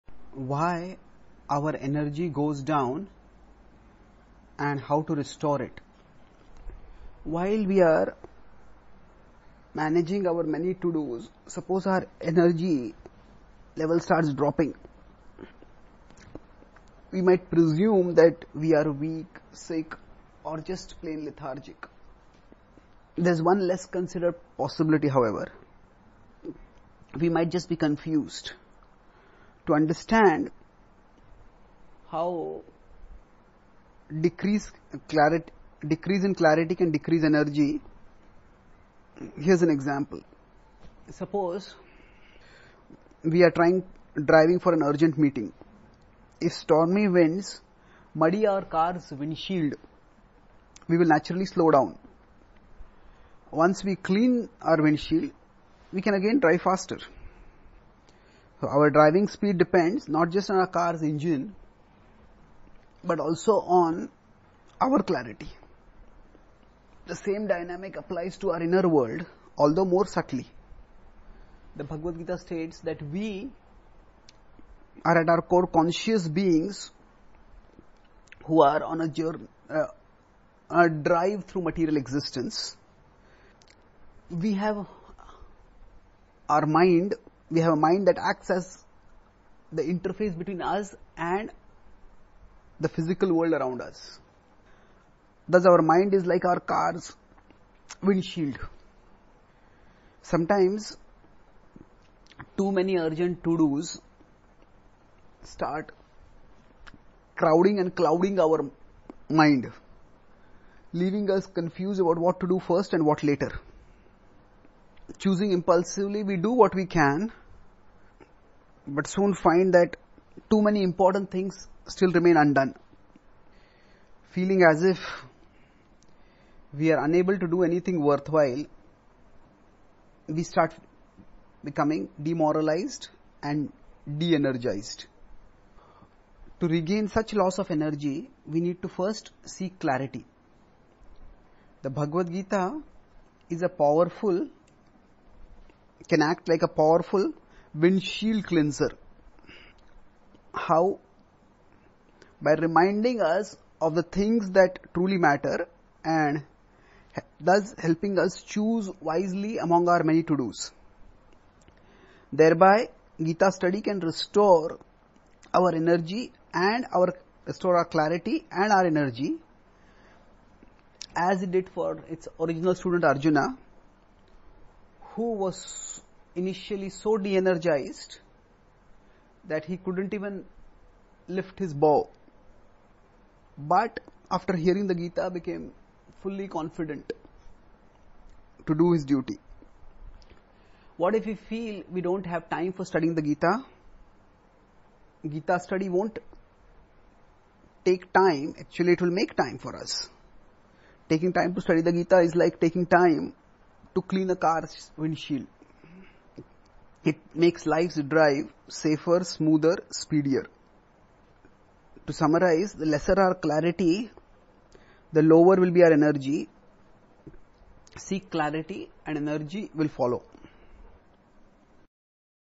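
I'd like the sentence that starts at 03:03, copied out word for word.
But after hearing the Gita, became fully confident to do his duty.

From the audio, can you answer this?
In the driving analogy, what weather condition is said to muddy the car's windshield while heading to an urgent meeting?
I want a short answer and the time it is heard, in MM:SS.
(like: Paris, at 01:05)
Stormy winds, at 00:46.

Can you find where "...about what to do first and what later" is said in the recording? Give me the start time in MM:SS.
01:51.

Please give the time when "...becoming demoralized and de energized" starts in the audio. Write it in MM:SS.
02:11.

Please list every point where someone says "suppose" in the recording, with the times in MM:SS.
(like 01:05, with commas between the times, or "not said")
00:11, 00:41.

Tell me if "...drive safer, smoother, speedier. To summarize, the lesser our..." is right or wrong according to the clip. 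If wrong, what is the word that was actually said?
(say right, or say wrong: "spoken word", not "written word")
right.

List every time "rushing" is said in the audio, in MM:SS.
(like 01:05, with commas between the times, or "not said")
not said.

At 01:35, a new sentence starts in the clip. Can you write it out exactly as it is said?
Thus, our mind is like our car's windshield.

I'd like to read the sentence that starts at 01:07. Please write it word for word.
The same dynamic applies to our inner world, although more subtly.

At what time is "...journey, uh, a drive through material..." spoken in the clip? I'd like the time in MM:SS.
01:19.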